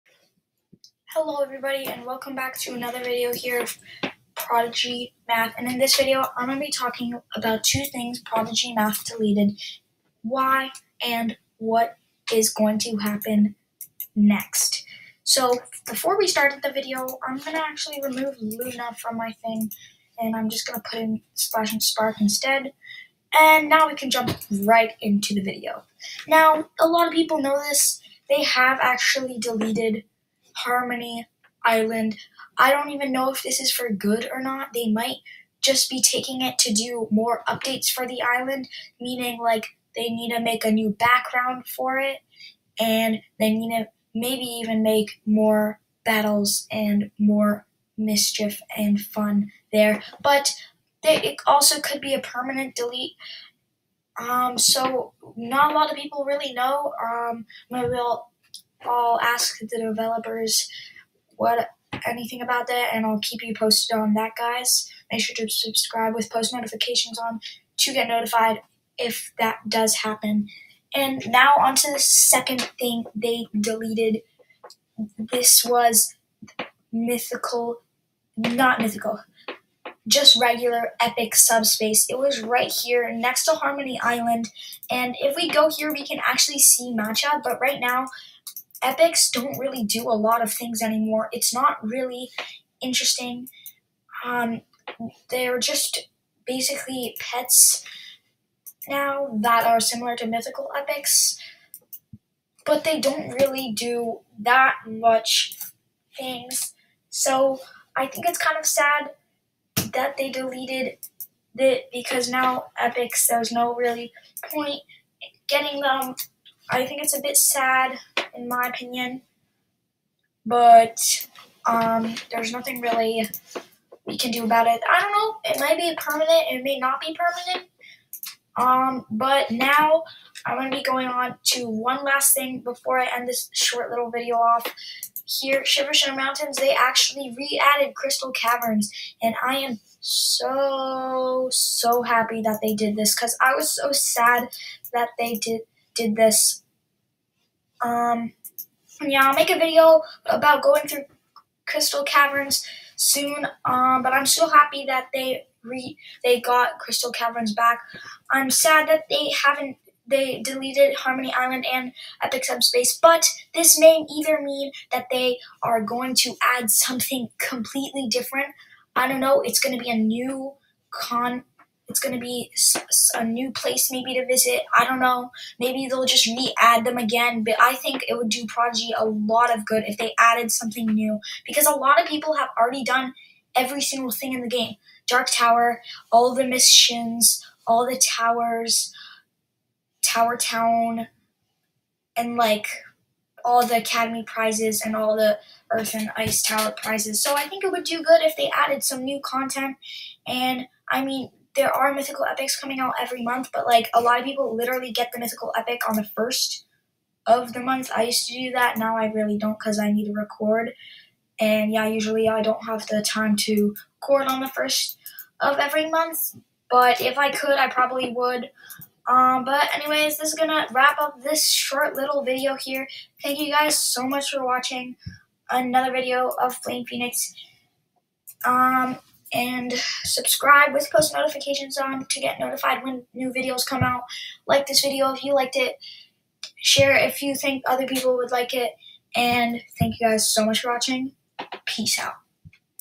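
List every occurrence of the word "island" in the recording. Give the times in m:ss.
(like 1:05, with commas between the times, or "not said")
0:31, 0:38, 1:24, 2:41.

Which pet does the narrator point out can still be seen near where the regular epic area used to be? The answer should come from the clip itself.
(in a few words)
Matcha.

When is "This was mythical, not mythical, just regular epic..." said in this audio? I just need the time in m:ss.
1:15.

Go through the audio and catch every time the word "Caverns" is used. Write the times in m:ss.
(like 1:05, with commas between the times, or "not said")
2:18, 2:32, 2:37.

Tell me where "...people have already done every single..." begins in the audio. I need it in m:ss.
3:02.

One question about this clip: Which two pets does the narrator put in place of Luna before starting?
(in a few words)
Splash and Spark.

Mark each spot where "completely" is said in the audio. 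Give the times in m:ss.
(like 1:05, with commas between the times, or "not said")
2:47.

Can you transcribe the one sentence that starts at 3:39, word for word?
Um, but anyways, this is gonna wrap up this short little video here.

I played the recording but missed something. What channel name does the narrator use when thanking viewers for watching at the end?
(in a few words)
Flame Phoenix.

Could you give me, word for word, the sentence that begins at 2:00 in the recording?
But um, there's nothing really we can do about it.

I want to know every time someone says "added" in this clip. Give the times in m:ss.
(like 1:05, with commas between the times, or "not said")
2:17, 3:00, 3:18.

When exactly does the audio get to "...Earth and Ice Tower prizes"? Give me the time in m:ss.
3:15.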